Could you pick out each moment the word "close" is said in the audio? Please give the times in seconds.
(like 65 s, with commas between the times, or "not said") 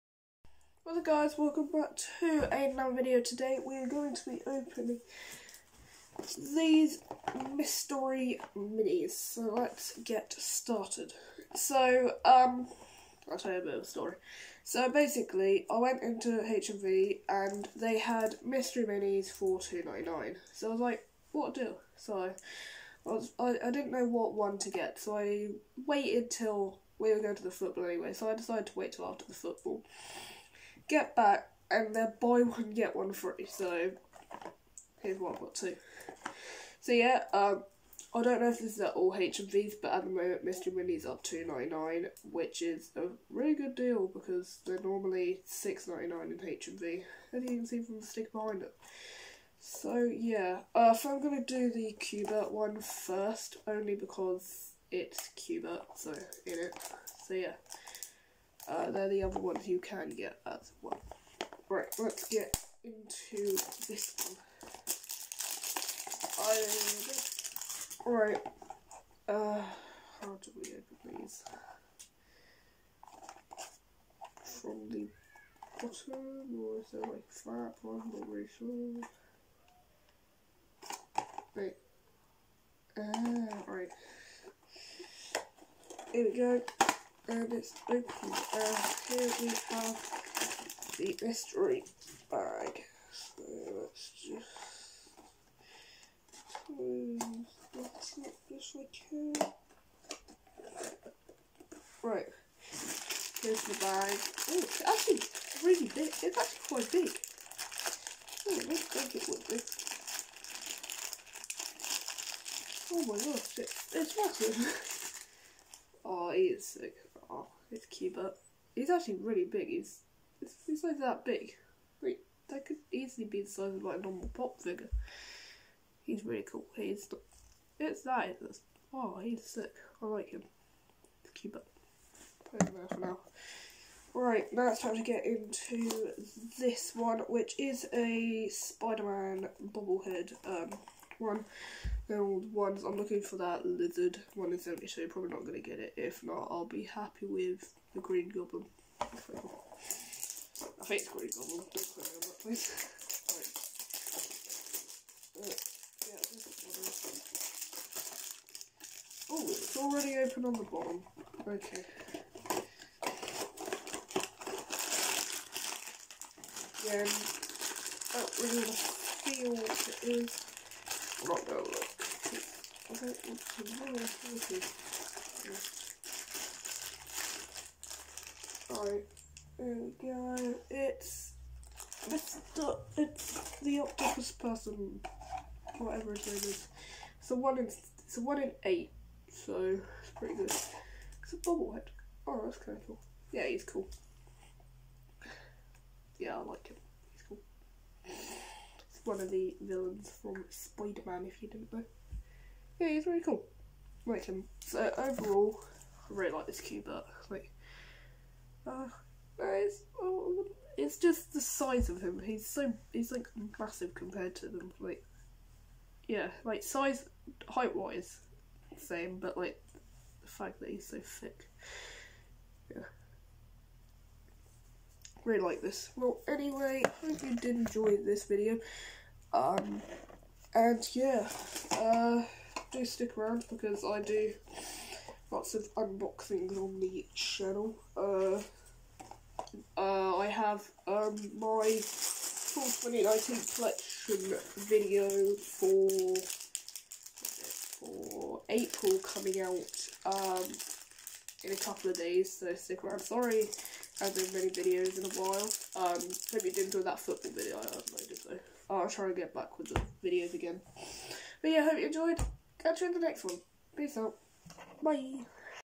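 96 s.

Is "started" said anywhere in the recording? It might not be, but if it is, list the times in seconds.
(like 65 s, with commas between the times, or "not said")
10 s.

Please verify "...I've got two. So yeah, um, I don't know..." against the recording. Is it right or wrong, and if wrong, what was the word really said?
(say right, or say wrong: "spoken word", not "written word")
right.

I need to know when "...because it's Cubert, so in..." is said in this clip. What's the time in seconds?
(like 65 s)
53 s.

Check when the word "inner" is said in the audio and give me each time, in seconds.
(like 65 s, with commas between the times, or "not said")
not said.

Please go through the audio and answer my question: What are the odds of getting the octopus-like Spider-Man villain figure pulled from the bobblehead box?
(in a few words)
1 in 8.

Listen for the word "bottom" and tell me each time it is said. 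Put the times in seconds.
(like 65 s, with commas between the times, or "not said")
75 s, 160 s.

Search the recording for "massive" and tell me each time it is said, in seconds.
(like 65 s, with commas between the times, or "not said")
114 s, 213 s.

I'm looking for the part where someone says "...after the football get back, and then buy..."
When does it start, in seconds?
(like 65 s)
29 s.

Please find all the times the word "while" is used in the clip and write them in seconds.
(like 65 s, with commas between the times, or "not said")
255 s.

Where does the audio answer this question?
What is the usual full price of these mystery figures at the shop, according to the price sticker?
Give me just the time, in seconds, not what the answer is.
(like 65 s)
45 s.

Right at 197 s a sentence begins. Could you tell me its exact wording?
He's cool one of the villains from Spider-Man, if you didn't know.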